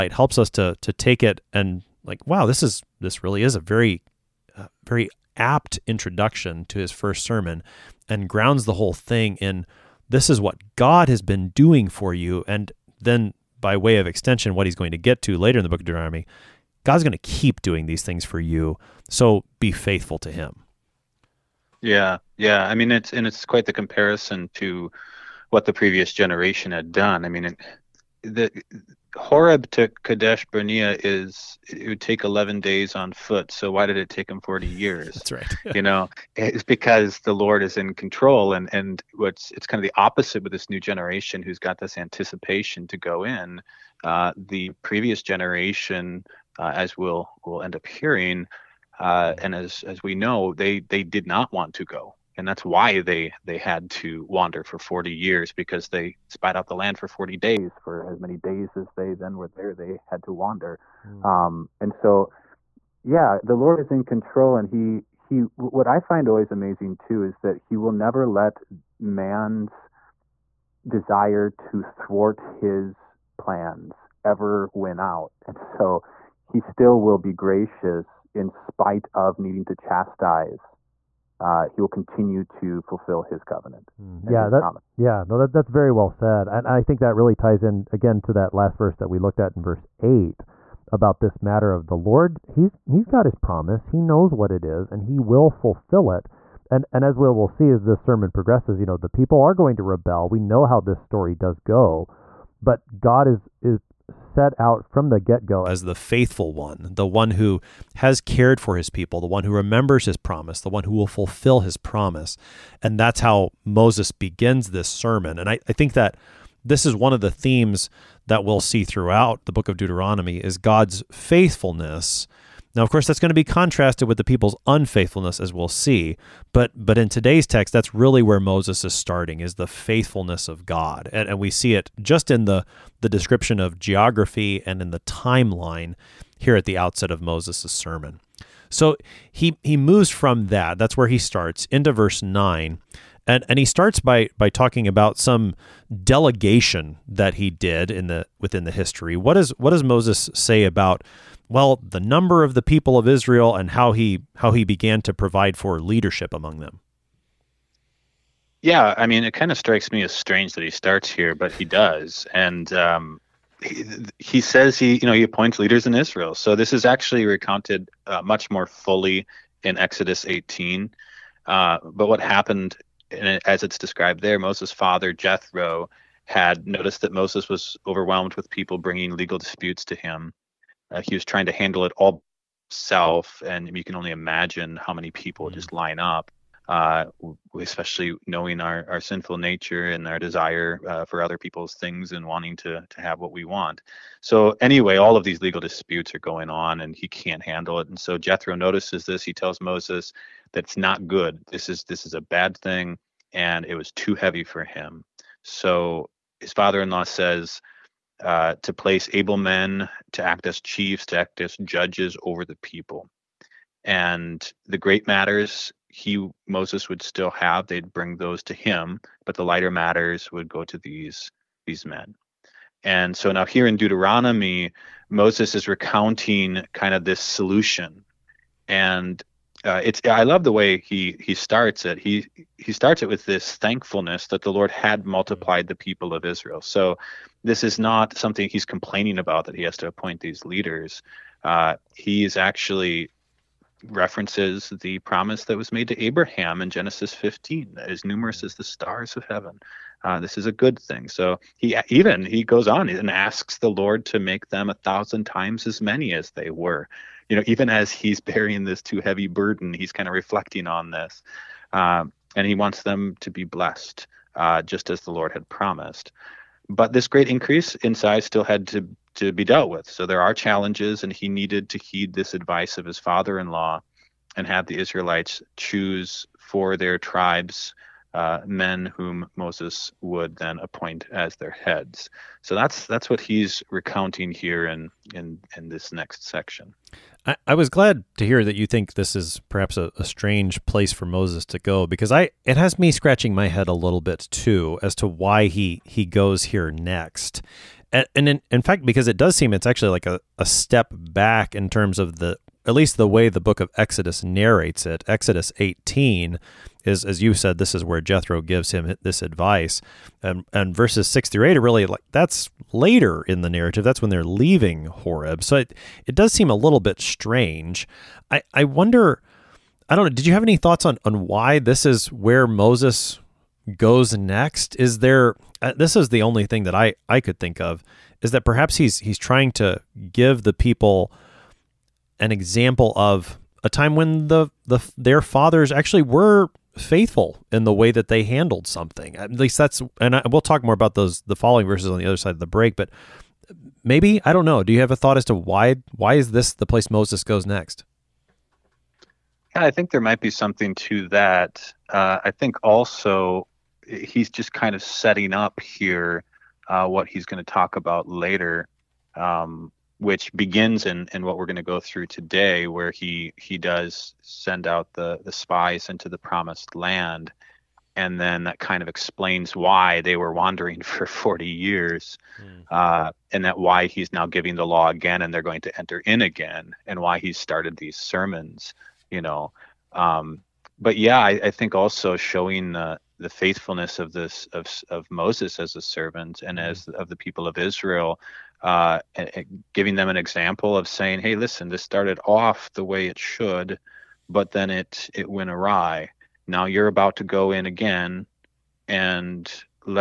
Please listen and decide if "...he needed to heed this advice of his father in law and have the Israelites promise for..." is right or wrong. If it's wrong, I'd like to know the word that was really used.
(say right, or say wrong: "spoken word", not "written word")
wrong: "choose", not "promise".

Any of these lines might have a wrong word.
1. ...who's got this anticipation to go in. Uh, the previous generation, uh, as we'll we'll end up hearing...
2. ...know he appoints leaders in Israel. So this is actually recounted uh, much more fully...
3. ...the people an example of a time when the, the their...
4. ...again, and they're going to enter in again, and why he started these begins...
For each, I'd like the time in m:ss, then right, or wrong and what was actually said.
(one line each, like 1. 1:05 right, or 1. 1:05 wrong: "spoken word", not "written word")
1. 0:41 right
2. 2:45 right
3. 5:30 right
4. 6:14 wrong: "sermons", not "begins".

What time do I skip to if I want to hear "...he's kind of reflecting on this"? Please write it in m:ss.
4:19.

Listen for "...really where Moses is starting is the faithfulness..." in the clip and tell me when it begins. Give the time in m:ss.
2:07.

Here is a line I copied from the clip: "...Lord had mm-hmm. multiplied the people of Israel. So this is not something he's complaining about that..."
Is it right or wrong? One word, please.
right.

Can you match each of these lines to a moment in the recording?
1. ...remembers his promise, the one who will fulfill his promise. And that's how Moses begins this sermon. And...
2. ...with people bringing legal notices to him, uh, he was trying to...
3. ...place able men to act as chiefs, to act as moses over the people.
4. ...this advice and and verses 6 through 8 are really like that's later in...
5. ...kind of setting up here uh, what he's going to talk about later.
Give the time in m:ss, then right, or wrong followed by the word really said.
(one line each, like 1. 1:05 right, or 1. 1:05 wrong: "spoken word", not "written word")
1. 1:49 right
2. 2:58 wrong: "disputes", not "notices"
3. 3:28 wrong: "judges", not "moses"
4. 5:09 right
5. 5:54 right.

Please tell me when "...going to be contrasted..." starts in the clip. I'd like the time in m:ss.
2:03.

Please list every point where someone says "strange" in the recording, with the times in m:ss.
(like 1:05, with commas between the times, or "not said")
2:40, 4:50, 5:17.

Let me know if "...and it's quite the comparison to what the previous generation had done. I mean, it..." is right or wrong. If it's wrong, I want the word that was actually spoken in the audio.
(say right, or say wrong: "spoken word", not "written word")
right.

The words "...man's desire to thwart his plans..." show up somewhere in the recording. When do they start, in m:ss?
1:08.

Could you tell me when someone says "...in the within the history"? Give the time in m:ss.
2:27.